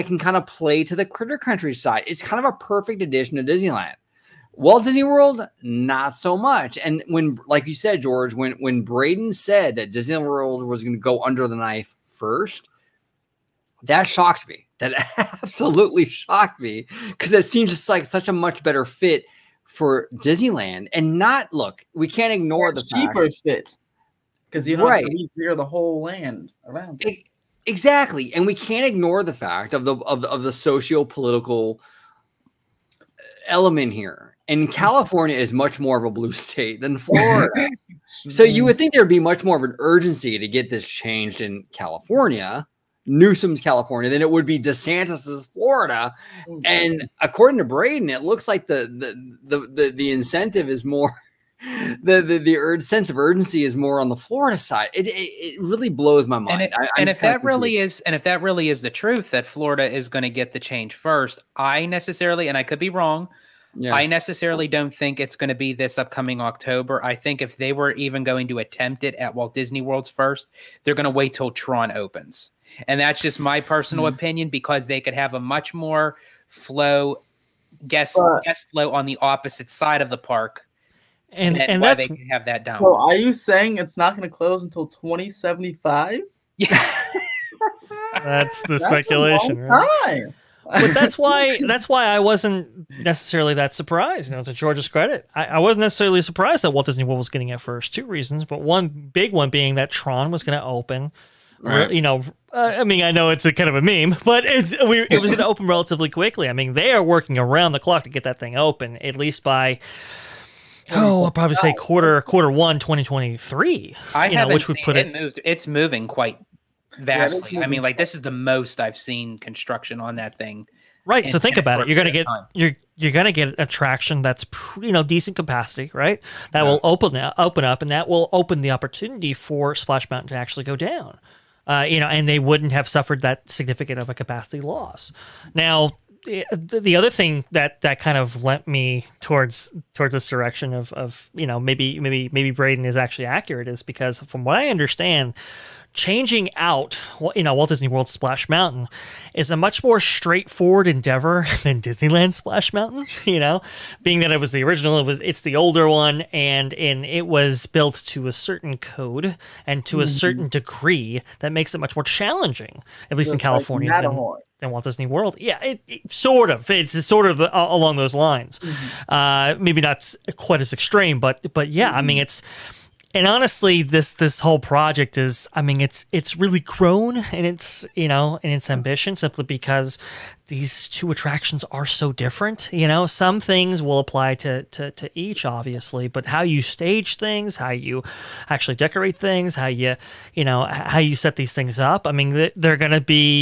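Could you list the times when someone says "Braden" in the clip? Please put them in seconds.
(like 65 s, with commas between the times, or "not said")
8 s, 47 s, 142 s.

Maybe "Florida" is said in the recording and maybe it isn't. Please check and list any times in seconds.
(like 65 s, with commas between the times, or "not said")
36 s, 45 s, 54 s, 59 s.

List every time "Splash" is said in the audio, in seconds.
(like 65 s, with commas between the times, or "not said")
129 s, 148 s, 152 s.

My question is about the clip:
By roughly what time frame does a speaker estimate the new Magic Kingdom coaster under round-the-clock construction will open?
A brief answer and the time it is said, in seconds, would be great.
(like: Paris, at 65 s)
Quarter one, 2023, at 112 s.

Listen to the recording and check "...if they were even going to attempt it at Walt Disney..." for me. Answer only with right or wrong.
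right.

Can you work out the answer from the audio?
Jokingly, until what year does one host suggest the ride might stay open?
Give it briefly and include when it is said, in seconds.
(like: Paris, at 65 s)
2075, at 84 s.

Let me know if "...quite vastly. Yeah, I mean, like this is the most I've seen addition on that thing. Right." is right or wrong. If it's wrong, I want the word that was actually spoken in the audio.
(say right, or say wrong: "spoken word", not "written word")
wrong: "construction", not "addition".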